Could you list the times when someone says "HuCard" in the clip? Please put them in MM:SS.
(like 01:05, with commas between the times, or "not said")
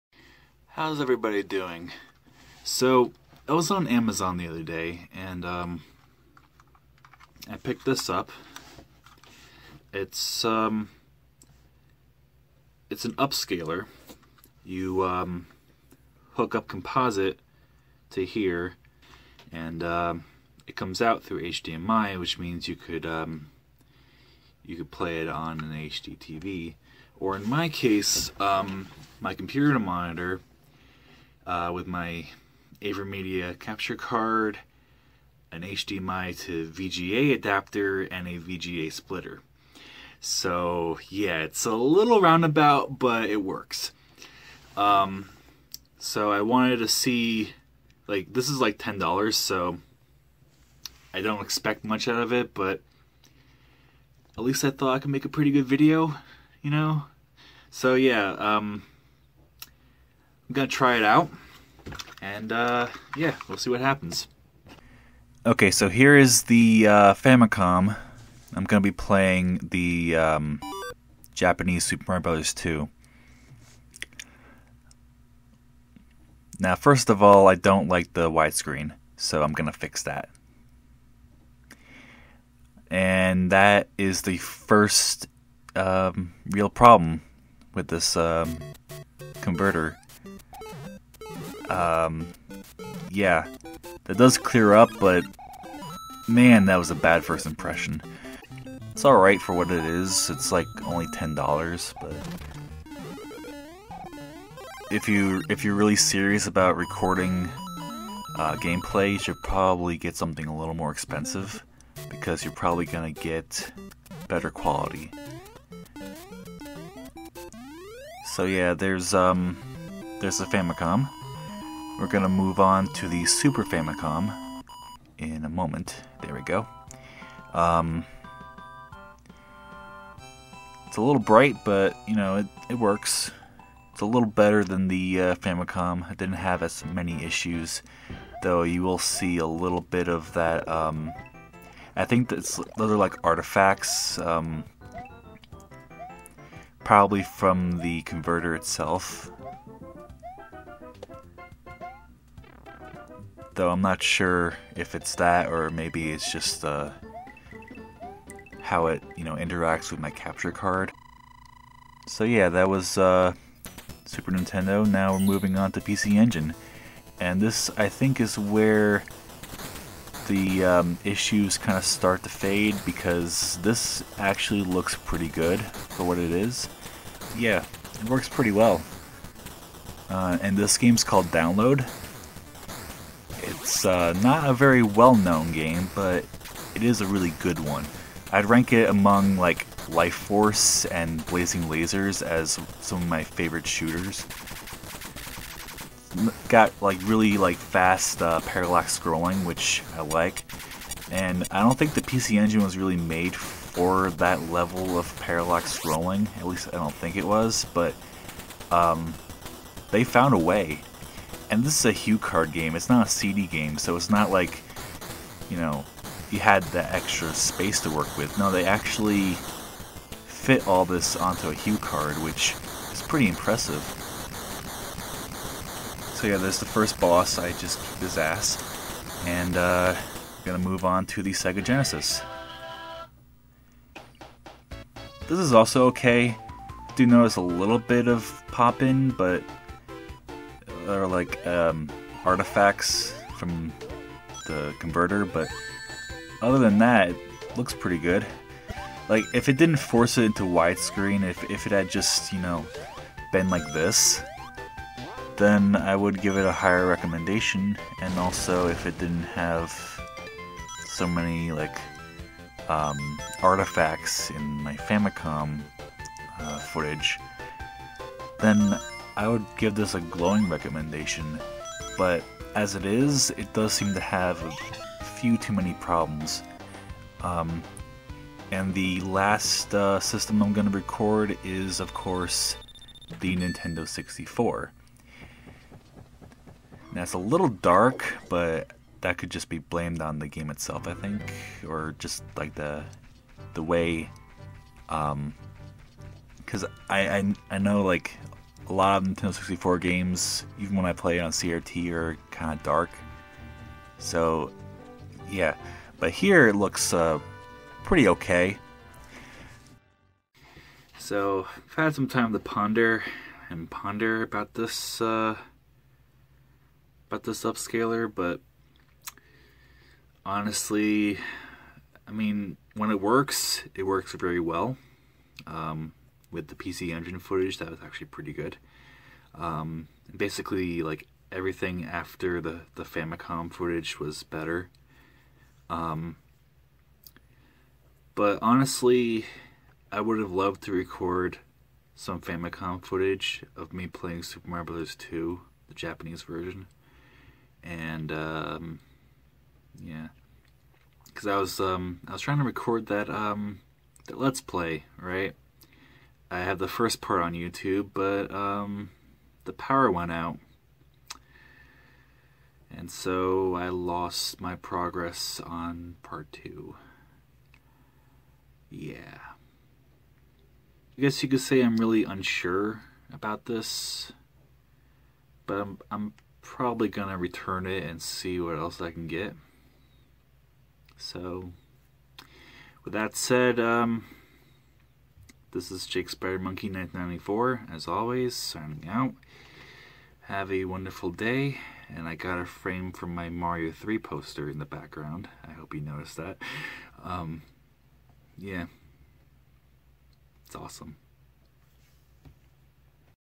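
03:31, 03:41.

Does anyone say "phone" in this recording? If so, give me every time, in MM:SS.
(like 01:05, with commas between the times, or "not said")
not said.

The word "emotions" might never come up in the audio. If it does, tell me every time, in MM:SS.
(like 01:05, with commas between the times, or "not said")
not said.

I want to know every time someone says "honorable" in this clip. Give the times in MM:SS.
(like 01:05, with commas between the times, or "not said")
not said.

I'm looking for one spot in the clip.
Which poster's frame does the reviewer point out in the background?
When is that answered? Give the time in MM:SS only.
06:33.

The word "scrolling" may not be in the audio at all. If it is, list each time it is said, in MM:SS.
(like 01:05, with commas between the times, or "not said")
03:18, 03:25.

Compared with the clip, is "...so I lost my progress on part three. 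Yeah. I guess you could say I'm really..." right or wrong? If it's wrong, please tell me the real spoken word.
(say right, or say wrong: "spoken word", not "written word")
wrong: "two", not "three".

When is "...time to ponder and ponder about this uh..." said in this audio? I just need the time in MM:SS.
05:12.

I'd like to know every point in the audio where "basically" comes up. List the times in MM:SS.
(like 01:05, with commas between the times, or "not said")
05:30.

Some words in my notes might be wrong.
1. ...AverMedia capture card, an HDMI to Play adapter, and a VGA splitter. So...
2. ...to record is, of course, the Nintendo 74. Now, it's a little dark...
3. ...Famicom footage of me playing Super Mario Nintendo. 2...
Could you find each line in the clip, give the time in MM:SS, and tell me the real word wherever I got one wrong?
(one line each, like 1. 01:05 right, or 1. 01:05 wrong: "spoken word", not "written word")
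1. 00:32 wrong: "VGA", not "Play"
2. 04:40 wrong: "64", not "74"
3. 05:42 wrong: "Bros", not "Nintendo".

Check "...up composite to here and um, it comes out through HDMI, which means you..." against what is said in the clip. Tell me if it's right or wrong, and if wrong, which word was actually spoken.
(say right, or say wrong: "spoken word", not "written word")
right.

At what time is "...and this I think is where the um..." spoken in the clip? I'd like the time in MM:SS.
02:47.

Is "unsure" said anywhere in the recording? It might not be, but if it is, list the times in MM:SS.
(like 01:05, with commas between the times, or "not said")
06:12.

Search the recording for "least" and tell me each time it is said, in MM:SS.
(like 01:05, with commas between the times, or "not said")
00:54, 03:26.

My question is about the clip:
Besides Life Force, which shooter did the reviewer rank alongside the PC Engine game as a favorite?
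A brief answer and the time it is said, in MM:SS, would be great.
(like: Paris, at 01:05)
Blazing Lasers, at 03:11.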